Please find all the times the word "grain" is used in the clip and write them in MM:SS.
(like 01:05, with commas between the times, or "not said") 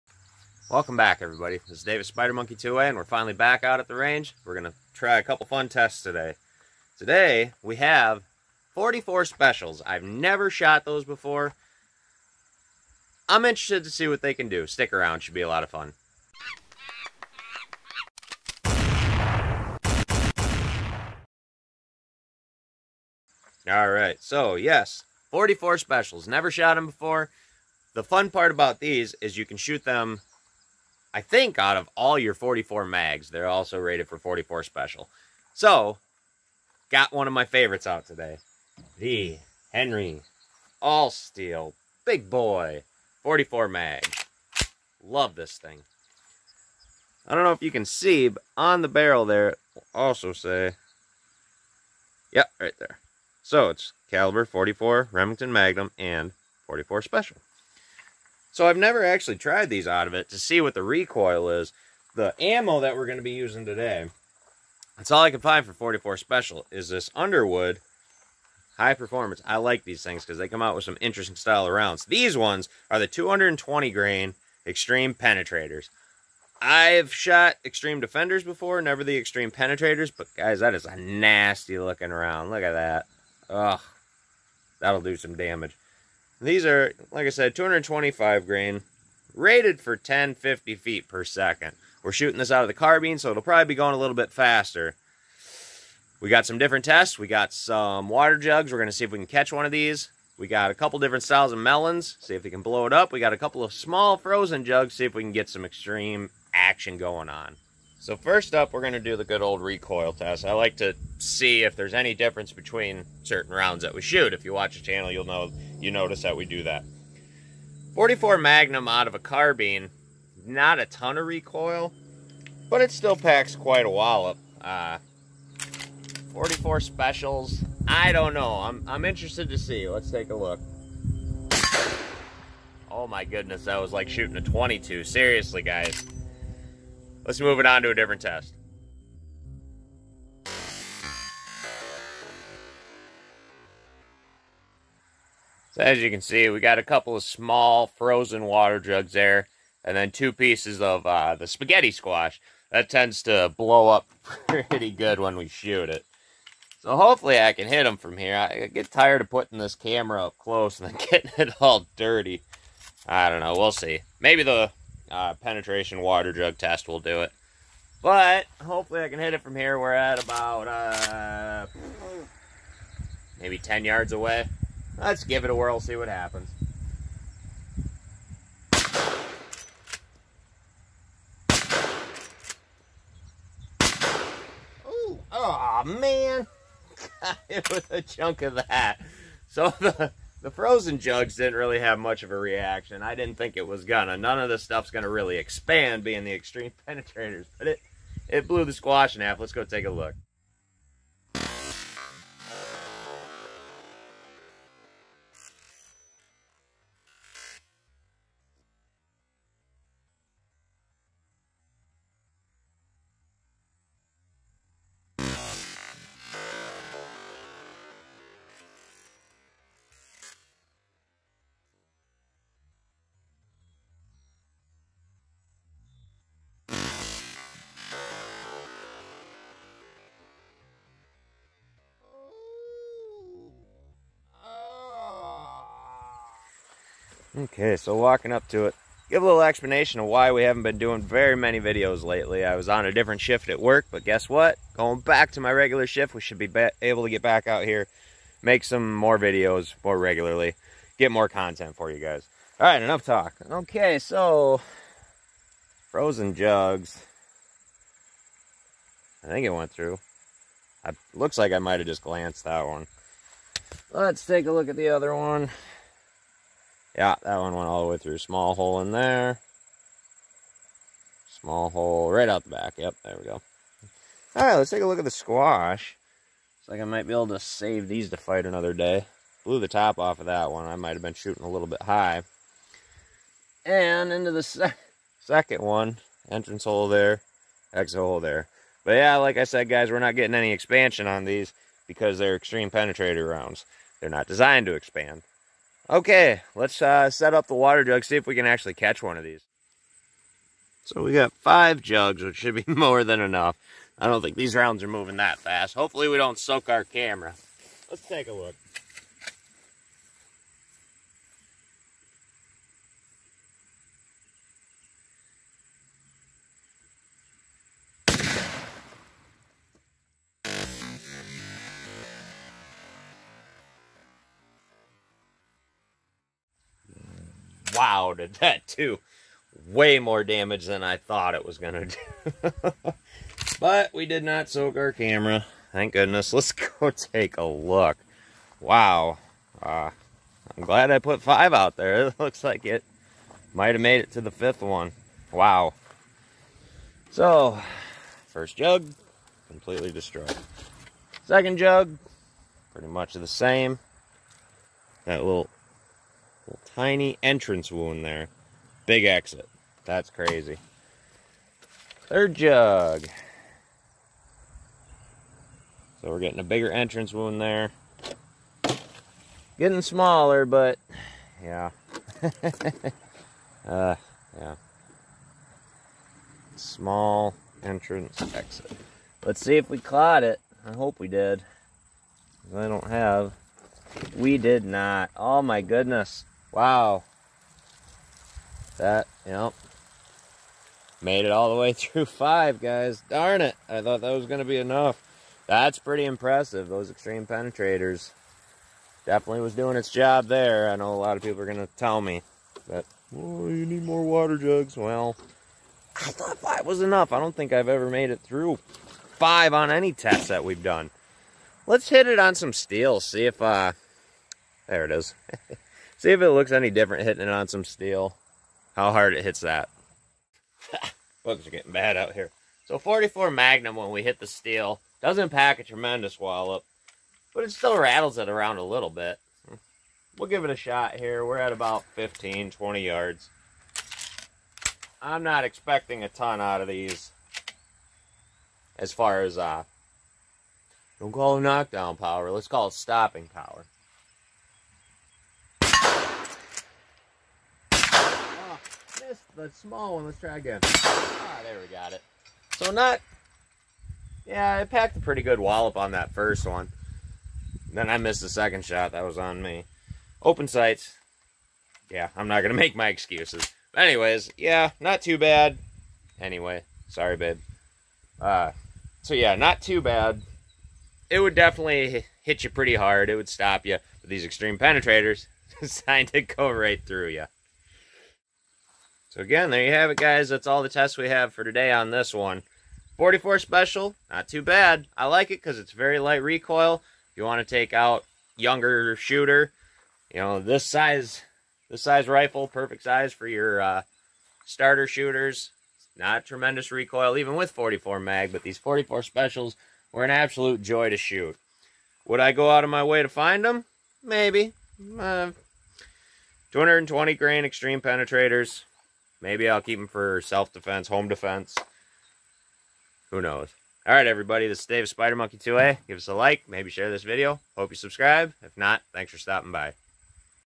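01:13, 01:28, 08:27.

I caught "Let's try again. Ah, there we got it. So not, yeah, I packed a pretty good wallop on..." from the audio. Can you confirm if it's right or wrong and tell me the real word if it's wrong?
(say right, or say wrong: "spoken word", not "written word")
right.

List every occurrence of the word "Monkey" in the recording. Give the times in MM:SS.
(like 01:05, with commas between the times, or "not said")
00:02, 08:35.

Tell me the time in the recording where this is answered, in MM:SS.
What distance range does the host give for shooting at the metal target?
07:11.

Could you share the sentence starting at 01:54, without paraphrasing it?
If you watch the channel, you'll know you notice that we do that.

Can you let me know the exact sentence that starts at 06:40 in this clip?
I know a lot of people are going to tell me that, oh, you need more water jugs.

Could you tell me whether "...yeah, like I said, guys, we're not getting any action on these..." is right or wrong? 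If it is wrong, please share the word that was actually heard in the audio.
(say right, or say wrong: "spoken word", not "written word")
wrong: "expansion", not "action".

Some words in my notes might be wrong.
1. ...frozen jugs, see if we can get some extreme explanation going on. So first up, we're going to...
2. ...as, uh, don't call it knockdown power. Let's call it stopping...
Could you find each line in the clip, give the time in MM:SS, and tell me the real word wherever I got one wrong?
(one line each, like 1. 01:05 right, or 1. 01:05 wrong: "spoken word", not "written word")
1. 01:44 wrong: "action", not "explanation"
2. 07:19 right.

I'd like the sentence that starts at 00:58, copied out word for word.
So I've never actually tried these out of it to see what the recoil is.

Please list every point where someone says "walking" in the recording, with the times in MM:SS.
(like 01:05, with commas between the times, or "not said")
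03:57.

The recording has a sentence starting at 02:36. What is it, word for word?
So hopefully I can hit them from here.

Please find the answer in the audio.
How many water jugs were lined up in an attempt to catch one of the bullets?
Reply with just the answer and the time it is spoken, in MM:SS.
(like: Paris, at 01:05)
5, at 05:01.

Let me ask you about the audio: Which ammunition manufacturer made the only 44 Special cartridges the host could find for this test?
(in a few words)
Underwood.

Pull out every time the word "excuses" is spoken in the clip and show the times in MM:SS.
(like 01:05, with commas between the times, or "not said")
07:42.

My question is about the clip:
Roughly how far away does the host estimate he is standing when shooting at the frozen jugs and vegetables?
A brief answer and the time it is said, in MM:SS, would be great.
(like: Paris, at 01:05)
10 yards, at 02:53.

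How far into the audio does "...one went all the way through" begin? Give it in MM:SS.
04:27.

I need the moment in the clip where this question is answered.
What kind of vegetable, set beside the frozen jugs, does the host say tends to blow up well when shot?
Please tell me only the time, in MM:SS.
02:31.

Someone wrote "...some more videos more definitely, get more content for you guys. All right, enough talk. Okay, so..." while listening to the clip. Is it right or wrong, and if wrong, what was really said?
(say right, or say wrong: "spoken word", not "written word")
wrong: "regularly", not "definitely".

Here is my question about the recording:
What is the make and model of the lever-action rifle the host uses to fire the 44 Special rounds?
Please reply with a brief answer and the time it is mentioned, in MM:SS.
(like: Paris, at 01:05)
Henry All Steel Big Boy, at 00:39.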